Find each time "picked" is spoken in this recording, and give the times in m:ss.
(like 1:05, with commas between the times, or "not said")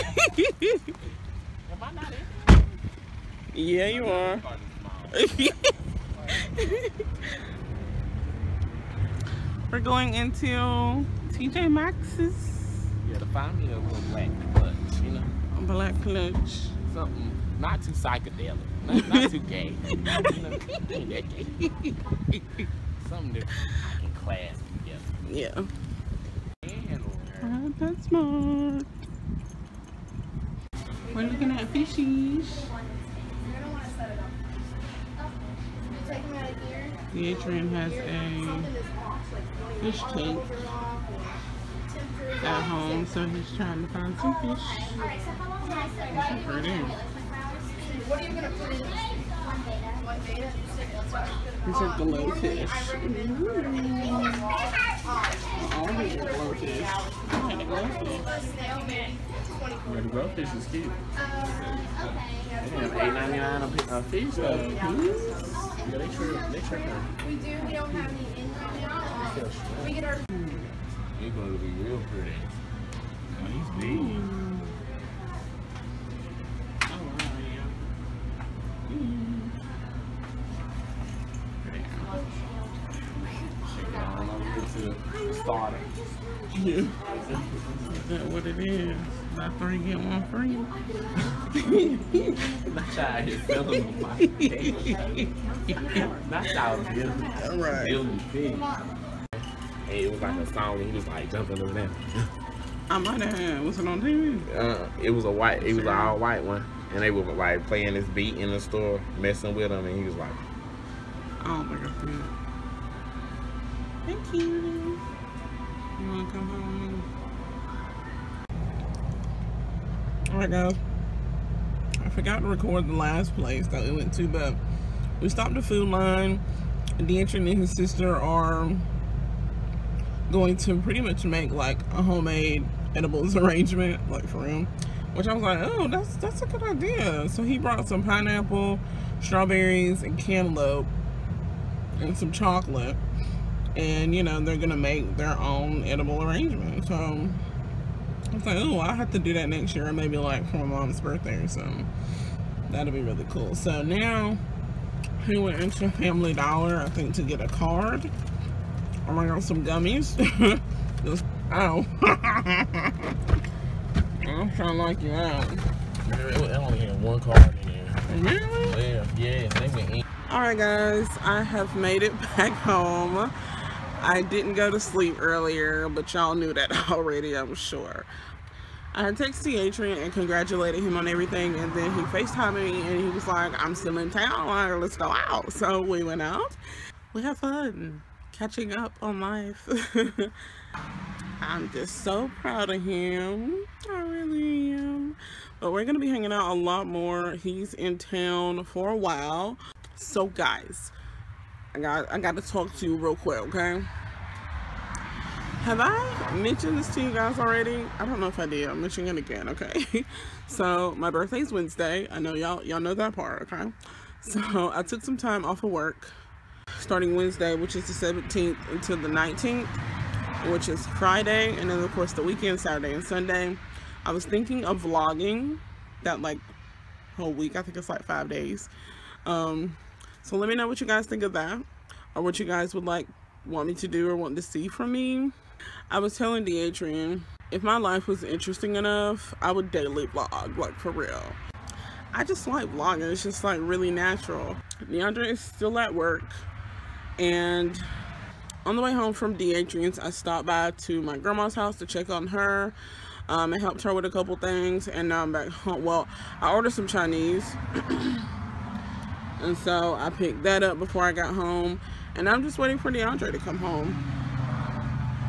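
4:20.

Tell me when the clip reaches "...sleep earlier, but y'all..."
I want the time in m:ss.
2:54.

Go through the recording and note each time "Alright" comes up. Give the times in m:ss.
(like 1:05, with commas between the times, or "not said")
2:00, 2:50.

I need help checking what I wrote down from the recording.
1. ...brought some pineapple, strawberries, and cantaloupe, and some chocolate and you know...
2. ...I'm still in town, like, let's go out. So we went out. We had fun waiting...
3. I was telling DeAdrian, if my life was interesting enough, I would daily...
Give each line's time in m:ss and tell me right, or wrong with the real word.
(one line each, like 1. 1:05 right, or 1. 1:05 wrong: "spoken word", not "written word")
1. 2:17 right
2. 3:03 wrong: "catching", not "waiting"
3. 3:55 right.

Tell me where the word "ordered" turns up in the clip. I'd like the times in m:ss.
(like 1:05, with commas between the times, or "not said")
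4:16.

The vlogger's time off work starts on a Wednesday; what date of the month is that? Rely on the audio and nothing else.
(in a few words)
17th.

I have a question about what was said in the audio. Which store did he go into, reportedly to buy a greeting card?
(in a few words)
Family Dollar.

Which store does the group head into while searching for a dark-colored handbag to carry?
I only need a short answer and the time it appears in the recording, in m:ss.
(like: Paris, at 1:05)
TJ Maxx, at 0:11.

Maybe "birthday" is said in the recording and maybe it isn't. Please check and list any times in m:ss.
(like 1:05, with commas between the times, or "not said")
2:30, 3:31.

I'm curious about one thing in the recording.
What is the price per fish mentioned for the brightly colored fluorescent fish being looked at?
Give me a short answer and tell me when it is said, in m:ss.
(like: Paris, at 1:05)
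$8.99, at 1:02.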